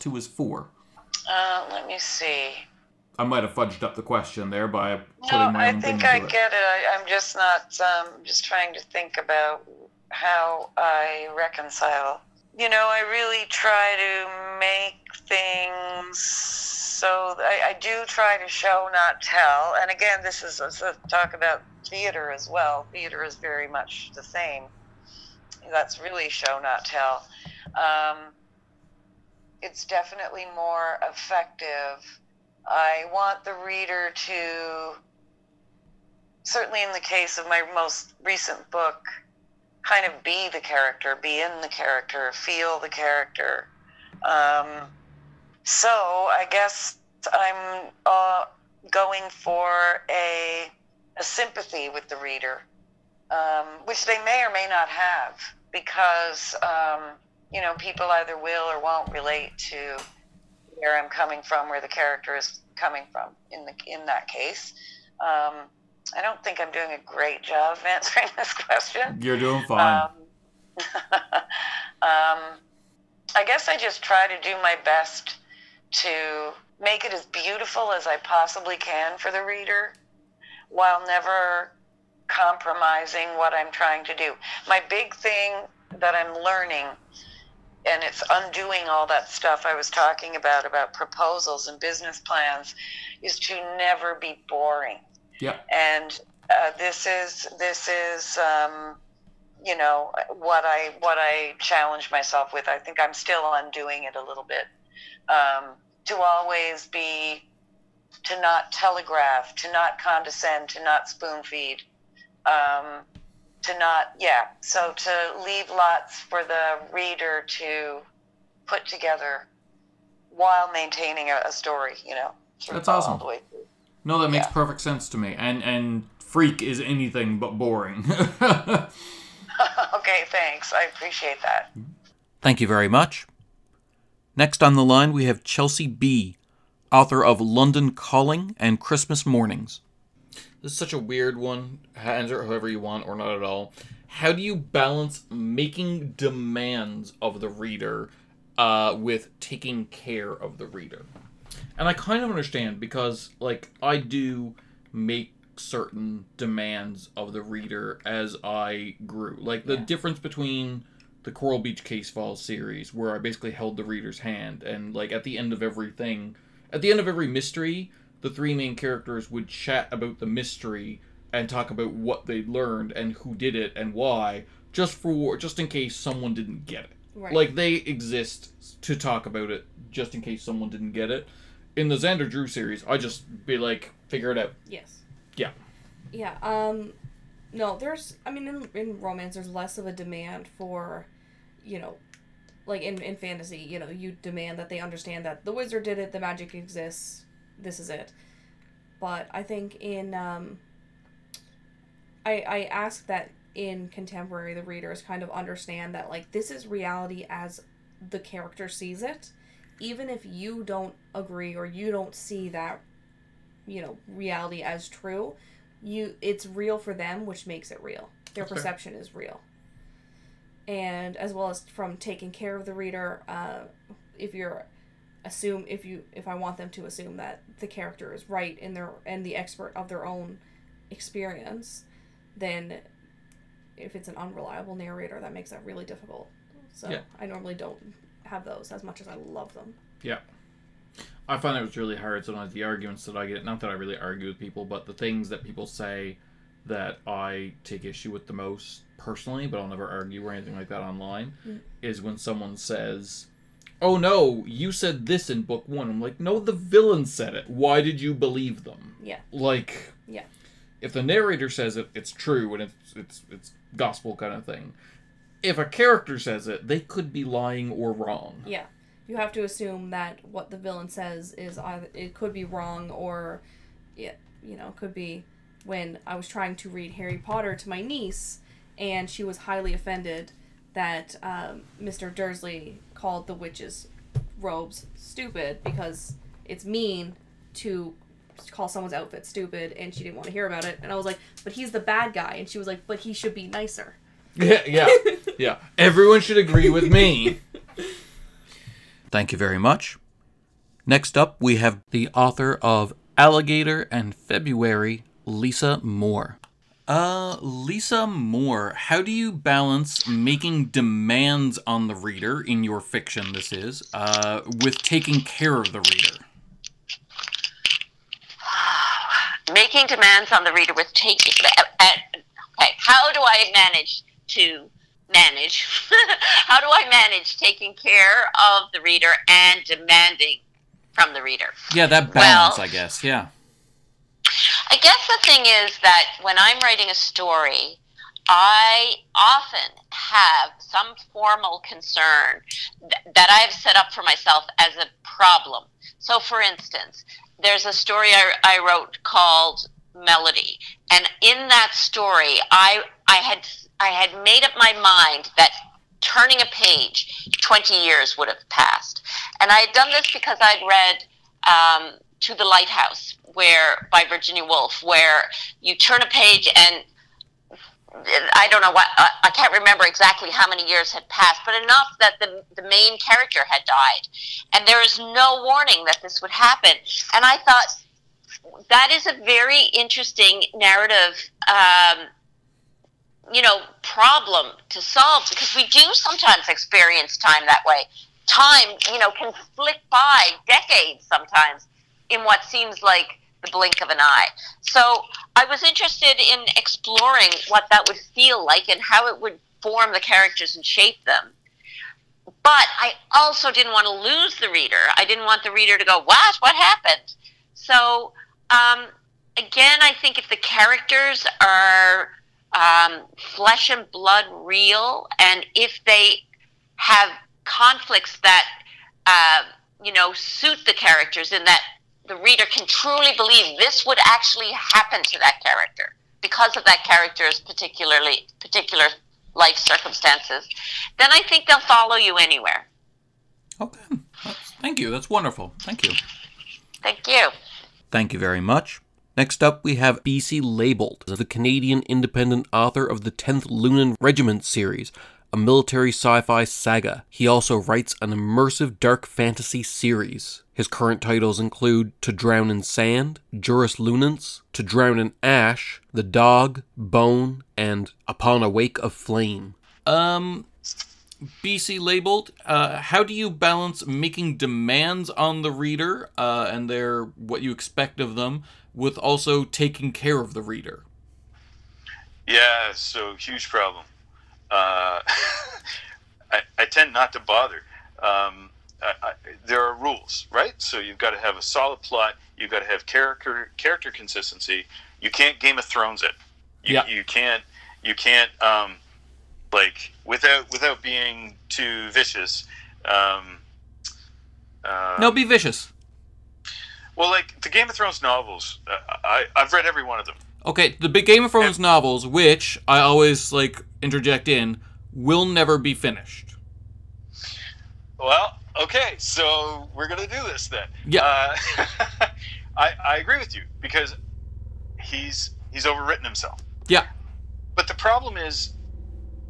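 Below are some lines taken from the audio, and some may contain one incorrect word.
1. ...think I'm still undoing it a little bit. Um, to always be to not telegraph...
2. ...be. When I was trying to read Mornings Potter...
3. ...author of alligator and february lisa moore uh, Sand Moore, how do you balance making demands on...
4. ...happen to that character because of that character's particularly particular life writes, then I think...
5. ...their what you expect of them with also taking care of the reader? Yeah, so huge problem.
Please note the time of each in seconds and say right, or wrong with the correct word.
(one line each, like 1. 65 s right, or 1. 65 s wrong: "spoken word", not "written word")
1. 102 s right
2. 274 s wrong: "Harry", not "Mornings"
3. 302 s wrong: "Lisa", not "Sand"
4. 424 s wrong: "circumstances", not "writes"
5. 466 s right.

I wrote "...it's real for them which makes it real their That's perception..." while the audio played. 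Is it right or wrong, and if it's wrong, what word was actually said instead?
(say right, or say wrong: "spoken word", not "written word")
right.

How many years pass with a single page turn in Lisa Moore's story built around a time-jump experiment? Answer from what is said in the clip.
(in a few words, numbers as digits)
20.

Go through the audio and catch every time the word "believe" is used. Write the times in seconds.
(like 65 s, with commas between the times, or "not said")
258 s, 423 s.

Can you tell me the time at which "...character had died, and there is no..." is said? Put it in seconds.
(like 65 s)
372 s.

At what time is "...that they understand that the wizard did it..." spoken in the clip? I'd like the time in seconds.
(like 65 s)
194 s.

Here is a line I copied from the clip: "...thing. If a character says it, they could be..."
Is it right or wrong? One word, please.
right.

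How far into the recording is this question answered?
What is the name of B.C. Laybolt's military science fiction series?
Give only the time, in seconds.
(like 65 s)
443 s.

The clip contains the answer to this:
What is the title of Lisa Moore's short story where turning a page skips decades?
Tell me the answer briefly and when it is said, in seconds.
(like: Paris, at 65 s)
Melody, at 349 s.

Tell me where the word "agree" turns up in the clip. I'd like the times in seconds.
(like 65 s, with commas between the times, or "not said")
211 s, 296 s, 512 s.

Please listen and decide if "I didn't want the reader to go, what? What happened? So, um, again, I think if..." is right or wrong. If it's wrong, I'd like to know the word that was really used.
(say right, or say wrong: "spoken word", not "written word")
right.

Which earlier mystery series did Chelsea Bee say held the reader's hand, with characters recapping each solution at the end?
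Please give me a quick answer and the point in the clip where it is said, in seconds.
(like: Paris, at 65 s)
Coral Beach Case Files, at 161 s.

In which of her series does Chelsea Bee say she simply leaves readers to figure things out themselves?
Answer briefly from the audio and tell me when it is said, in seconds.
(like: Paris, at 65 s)
Xander Drew, at 181 s.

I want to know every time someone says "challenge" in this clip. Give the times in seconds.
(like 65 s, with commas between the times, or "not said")
101 s.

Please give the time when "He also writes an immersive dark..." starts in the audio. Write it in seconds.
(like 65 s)
447 s.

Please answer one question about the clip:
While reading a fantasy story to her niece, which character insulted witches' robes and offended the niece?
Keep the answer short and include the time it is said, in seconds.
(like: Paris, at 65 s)
Mr. Dursley, at 281 s.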